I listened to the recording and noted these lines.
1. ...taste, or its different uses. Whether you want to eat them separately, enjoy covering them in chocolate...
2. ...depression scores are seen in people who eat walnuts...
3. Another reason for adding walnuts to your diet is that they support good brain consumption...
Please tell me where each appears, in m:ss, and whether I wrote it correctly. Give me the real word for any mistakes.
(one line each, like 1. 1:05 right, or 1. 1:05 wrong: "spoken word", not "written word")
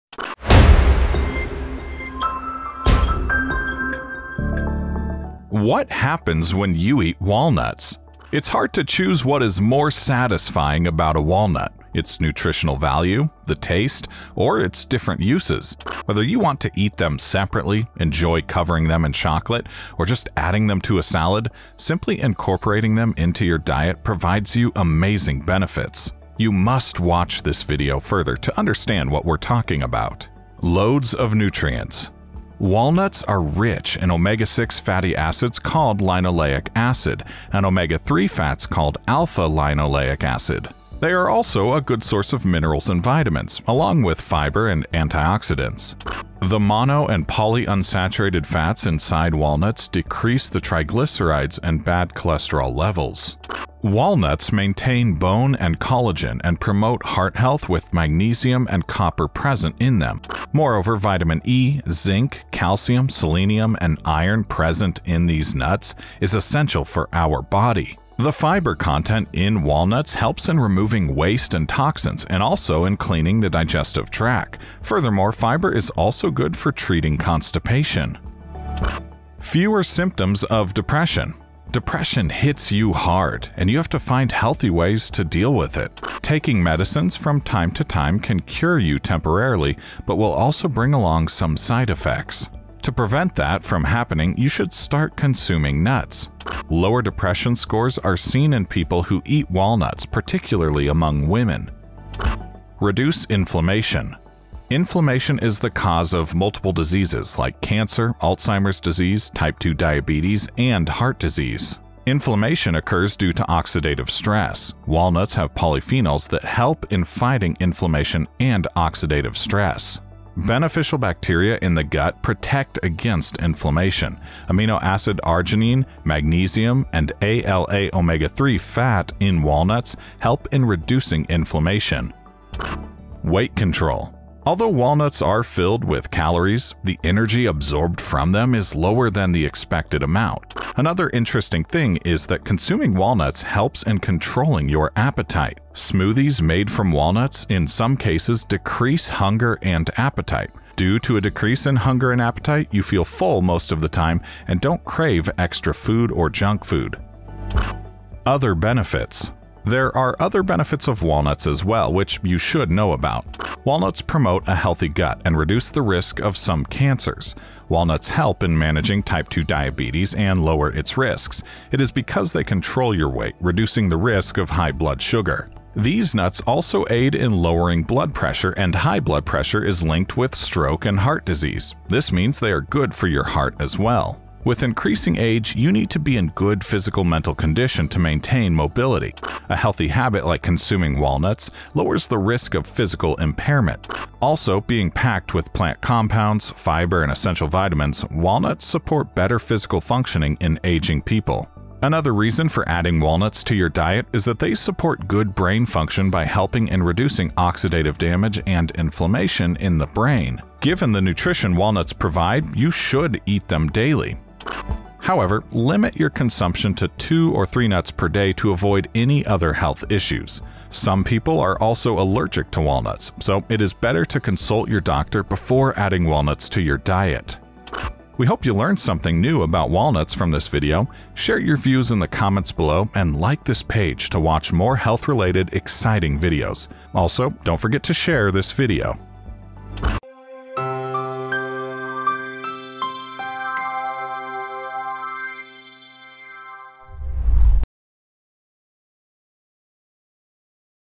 1. 0:13 right
2. 1:37 right
3. 3:21 wrong: "function", not "consumption".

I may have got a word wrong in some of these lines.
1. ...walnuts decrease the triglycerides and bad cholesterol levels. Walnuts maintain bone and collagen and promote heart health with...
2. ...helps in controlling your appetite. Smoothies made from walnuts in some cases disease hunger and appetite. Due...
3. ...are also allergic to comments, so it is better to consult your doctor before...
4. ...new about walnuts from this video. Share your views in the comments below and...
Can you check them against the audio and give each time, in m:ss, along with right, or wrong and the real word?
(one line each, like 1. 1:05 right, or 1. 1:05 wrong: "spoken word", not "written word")
1. 0:49 right
2. 2:23 wrong: "decrease", not "disease"
3. 3:41 wrong: "walnuts", not "comments"
4. 3:49 right.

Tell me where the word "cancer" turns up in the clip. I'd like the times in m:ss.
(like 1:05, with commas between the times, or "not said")
1:47, 2:46.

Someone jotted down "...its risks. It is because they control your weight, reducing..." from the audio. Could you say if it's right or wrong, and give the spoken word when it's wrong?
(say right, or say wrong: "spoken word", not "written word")
right.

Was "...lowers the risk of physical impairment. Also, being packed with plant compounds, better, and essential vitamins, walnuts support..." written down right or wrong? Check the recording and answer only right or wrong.
wrong.